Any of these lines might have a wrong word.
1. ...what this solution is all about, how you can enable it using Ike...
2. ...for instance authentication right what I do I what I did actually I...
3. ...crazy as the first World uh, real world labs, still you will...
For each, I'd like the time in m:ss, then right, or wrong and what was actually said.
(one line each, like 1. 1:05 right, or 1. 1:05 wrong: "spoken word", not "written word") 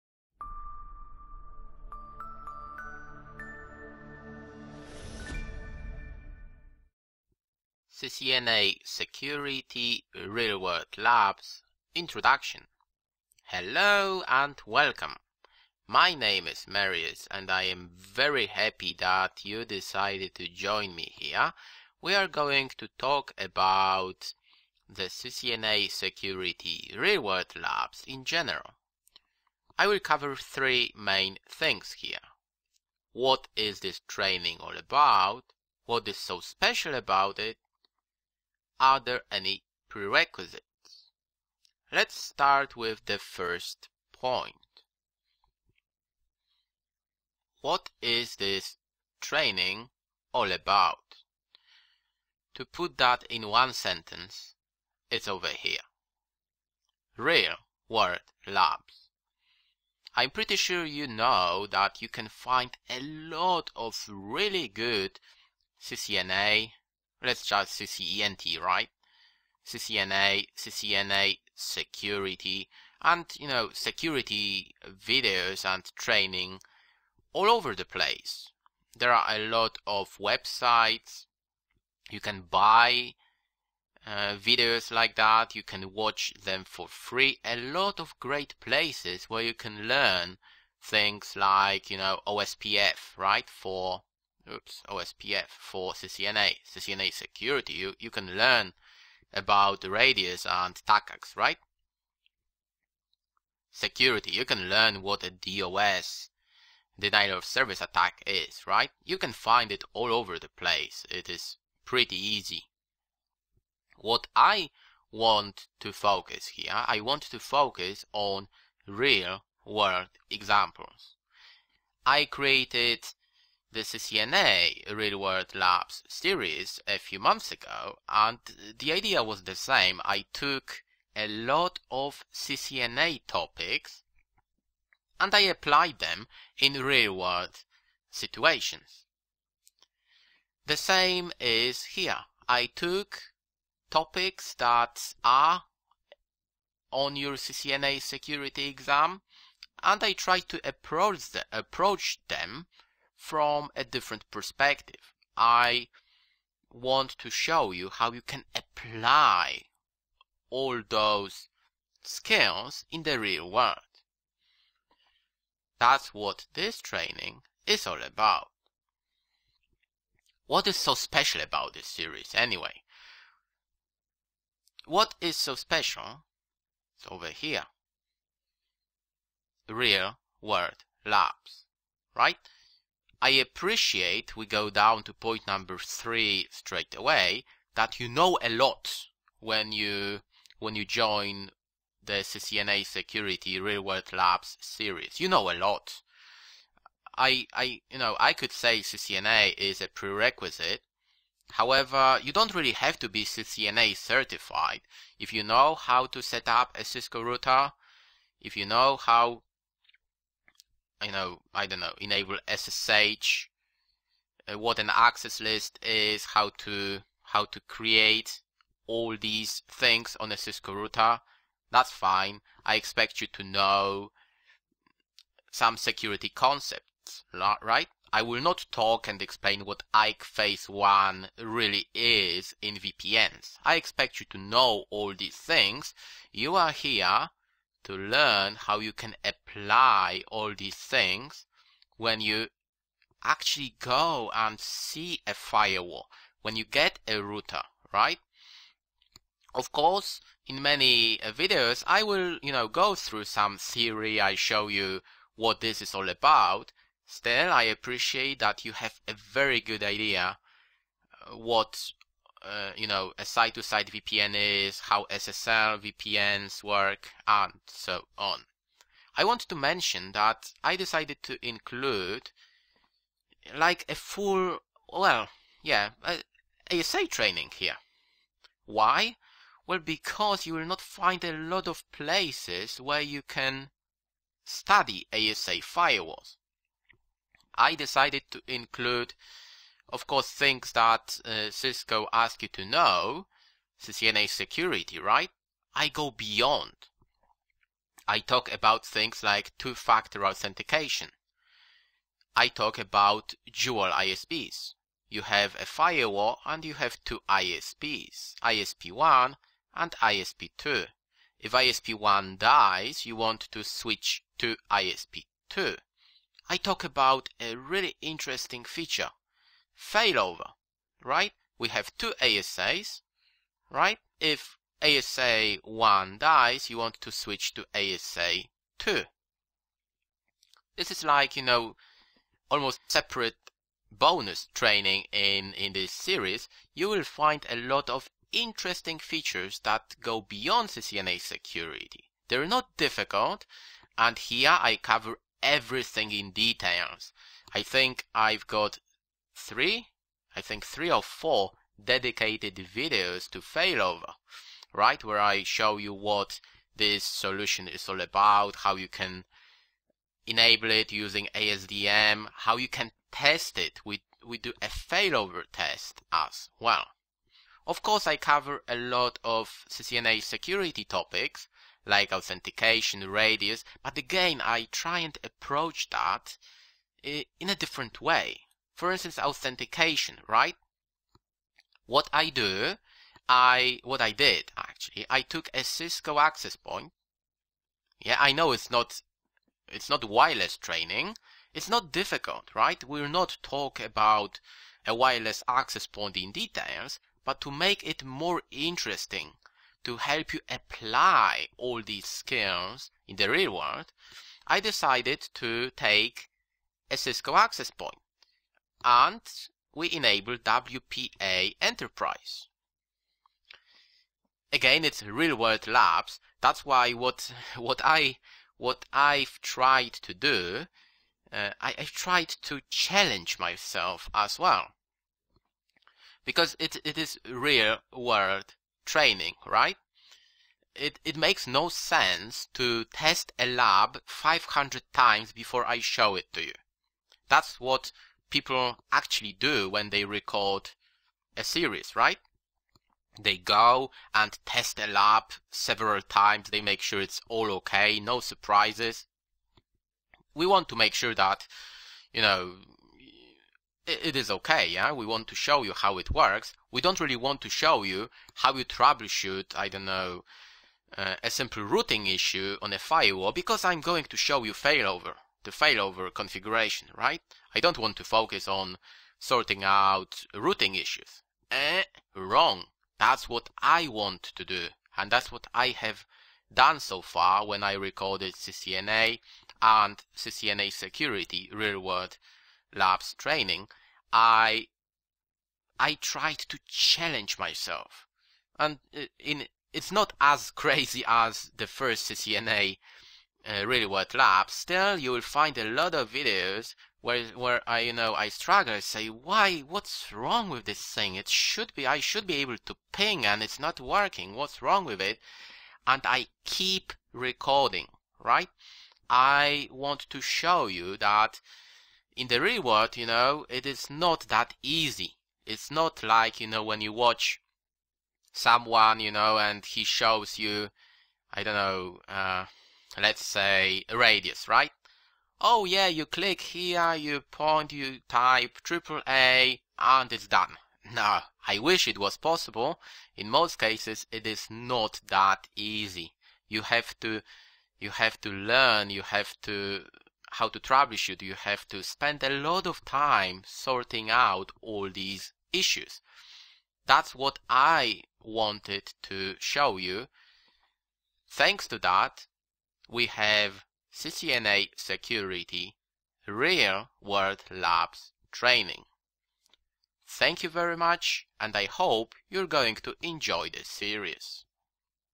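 1. 5:55 wrong: "ASDM", not "Ike"
2. 6:18 right
3. 8:10 wrong: "CCNA", not "World".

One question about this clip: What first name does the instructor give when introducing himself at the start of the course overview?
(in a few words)
Marius.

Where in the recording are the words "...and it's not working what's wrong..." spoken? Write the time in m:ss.
8:23.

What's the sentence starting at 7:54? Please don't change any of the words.
And that's what I have done so far when I recorded CCNA and CCNA security real-world labs training.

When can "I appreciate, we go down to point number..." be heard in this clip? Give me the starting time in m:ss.
3:03.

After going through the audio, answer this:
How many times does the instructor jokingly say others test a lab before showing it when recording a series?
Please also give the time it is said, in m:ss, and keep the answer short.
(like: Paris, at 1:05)
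500, at 7:14.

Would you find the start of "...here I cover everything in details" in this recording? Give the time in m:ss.
5:44.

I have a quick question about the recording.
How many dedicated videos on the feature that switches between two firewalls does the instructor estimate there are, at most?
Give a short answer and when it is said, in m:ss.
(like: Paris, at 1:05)
4, at 5:50.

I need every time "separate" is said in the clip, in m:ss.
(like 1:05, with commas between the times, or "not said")
5:32.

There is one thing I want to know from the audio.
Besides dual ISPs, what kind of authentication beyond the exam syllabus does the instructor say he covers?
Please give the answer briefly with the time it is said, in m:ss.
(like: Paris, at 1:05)
two-factor authentication, at 4:59.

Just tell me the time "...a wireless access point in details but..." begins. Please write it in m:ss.
6:34.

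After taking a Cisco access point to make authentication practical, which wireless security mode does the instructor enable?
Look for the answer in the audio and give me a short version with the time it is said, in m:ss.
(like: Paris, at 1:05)
WPA Enterprise, at 6:50.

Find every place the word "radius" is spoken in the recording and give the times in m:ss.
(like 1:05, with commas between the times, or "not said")
1:39, 6:13, 8:43.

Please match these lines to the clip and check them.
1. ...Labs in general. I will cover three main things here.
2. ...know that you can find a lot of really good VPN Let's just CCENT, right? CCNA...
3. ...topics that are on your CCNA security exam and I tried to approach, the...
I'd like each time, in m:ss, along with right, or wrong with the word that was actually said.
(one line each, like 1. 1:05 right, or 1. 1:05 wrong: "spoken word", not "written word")
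1. 0:27 right
2. 1:01 wrong: "CCNA", not "VPN"
3. 2:23 right.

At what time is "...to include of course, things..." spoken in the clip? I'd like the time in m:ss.
4:48.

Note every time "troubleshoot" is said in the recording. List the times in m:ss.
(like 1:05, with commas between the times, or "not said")
7:38, 9:00.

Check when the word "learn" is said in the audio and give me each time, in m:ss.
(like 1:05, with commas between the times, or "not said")
1:29, 1:38, 1:44, 3:57, 8:58.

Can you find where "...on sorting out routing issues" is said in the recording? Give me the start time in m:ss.
7:48.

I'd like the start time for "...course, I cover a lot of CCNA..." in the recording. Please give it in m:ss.
6:07.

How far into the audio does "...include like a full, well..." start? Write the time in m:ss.
4:31.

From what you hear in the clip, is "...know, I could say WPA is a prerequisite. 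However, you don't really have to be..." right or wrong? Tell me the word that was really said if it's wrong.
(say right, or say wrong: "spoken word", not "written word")
wrong: "CCNA", not "WPA".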